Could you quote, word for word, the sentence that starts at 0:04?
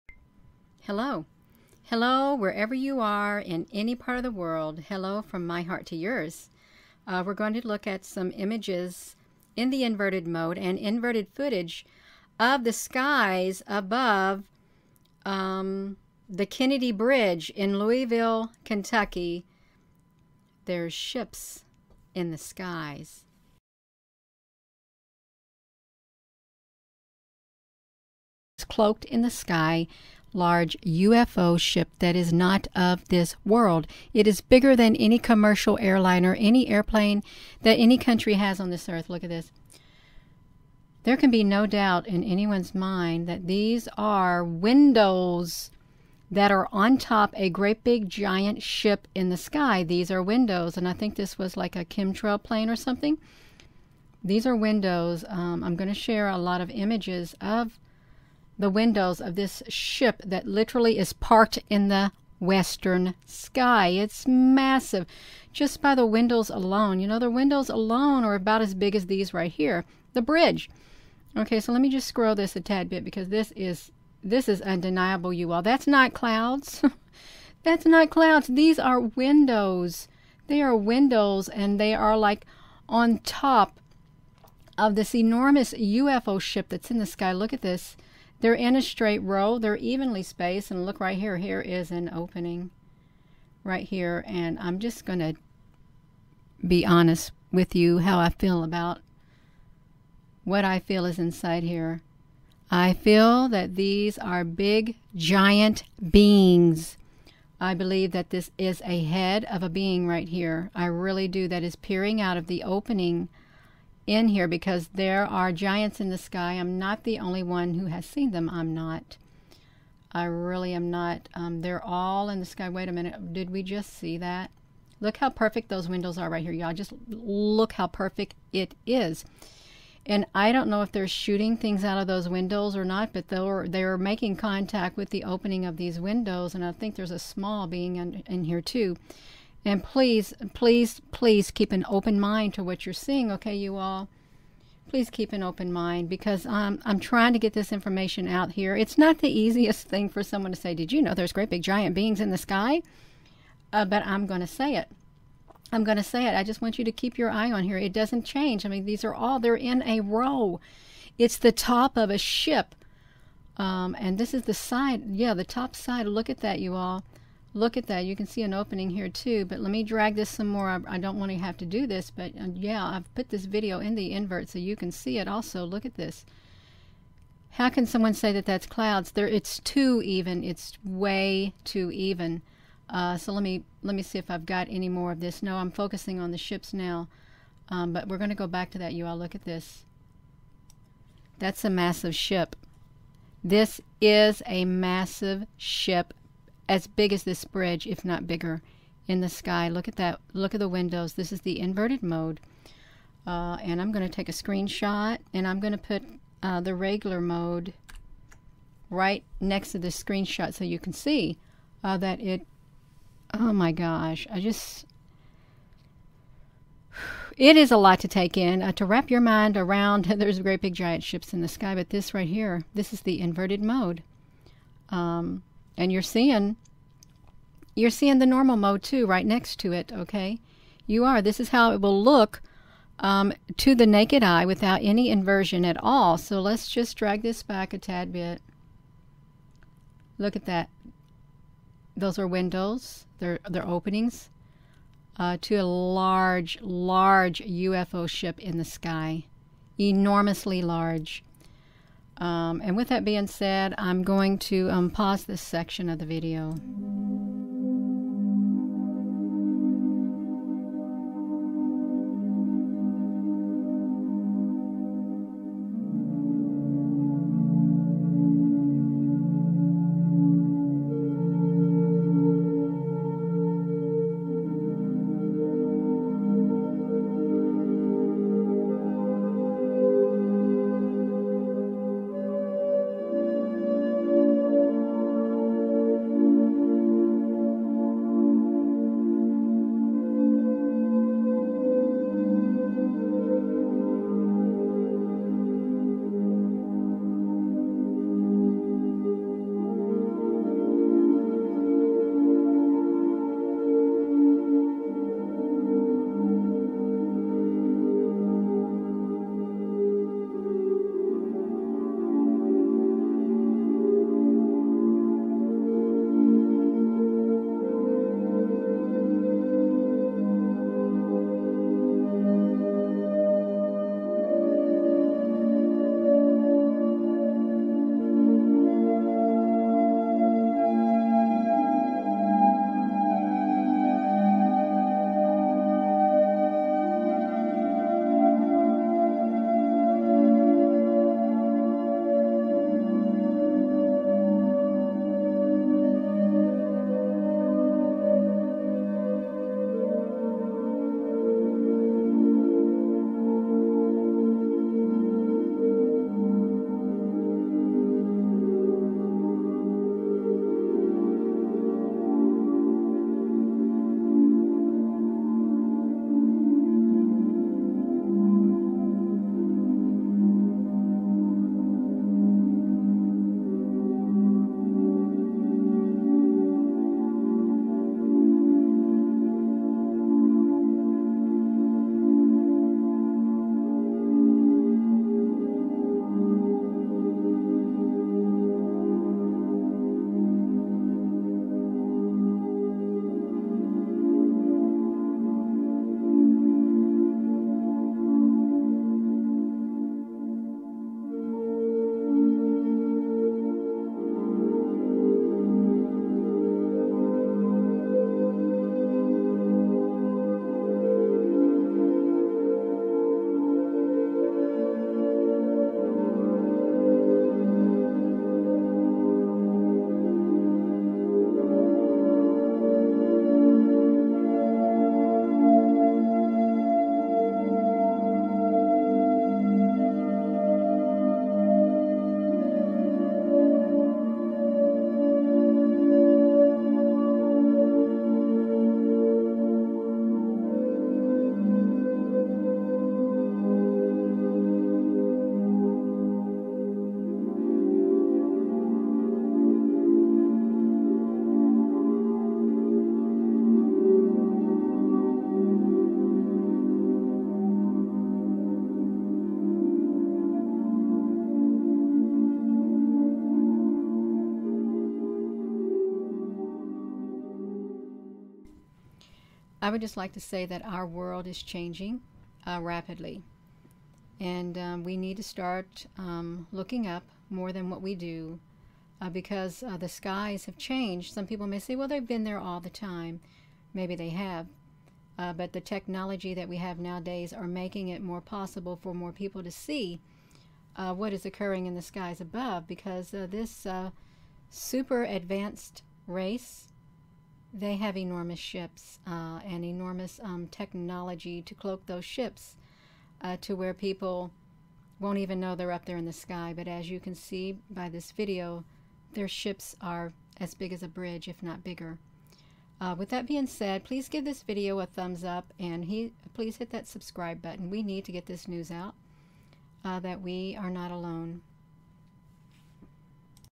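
Hello from my heart to yours.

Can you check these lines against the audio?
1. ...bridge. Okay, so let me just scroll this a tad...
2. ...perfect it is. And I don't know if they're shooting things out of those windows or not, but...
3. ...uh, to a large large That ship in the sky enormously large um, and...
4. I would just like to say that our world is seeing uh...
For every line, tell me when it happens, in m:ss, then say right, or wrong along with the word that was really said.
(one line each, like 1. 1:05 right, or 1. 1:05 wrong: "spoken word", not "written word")
1. 1:10 right
2. 2:07 right
3. 4:05 wrong: "UFO", not "That"
4. 7:49 wrong: "changing", not "seeing".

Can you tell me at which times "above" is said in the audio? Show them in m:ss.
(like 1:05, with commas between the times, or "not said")
0:13, 8:12.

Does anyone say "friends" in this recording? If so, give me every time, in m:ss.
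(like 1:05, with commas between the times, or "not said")
not said.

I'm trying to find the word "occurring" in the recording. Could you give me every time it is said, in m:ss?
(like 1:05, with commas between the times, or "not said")
8:11.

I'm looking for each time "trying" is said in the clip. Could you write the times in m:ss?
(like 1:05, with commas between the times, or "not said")
2:26.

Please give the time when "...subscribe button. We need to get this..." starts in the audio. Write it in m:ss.
8:36.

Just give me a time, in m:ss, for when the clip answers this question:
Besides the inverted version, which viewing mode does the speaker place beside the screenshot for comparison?
3:26.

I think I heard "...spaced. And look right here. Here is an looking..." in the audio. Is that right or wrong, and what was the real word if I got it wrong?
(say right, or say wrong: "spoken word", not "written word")
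wrong: "opening", not "looking".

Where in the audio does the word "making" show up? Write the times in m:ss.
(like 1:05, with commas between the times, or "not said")
2:13, 8:07.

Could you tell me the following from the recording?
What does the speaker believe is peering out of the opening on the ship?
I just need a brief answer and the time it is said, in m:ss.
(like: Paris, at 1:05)
head of a being, at 1:49.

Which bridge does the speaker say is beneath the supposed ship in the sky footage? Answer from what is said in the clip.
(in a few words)
Kennedy Bridge.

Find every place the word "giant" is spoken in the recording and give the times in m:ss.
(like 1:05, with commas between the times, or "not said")
0:48, 1:45, 1:55, 2:31, 3:40.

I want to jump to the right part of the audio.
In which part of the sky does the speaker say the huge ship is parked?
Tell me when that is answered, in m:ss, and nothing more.
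1:02.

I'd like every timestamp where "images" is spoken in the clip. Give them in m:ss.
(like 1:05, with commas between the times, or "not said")
0:08, 0:56.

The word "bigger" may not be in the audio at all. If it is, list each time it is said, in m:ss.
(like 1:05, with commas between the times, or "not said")
0:34, 3:18, 8:31.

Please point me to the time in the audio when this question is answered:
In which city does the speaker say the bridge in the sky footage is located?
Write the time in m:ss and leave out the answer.
0:17.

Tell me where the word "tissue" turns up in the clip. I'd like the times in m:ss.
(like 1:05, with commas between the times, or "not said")
not said.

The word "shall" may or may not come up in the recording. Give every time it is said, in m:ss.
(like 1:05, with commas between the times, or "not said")
not said.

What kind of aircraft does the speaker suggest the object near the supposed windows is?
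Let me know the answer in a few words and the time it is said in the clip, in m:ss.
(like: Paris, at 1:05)
chemtrail plane, at 0:51.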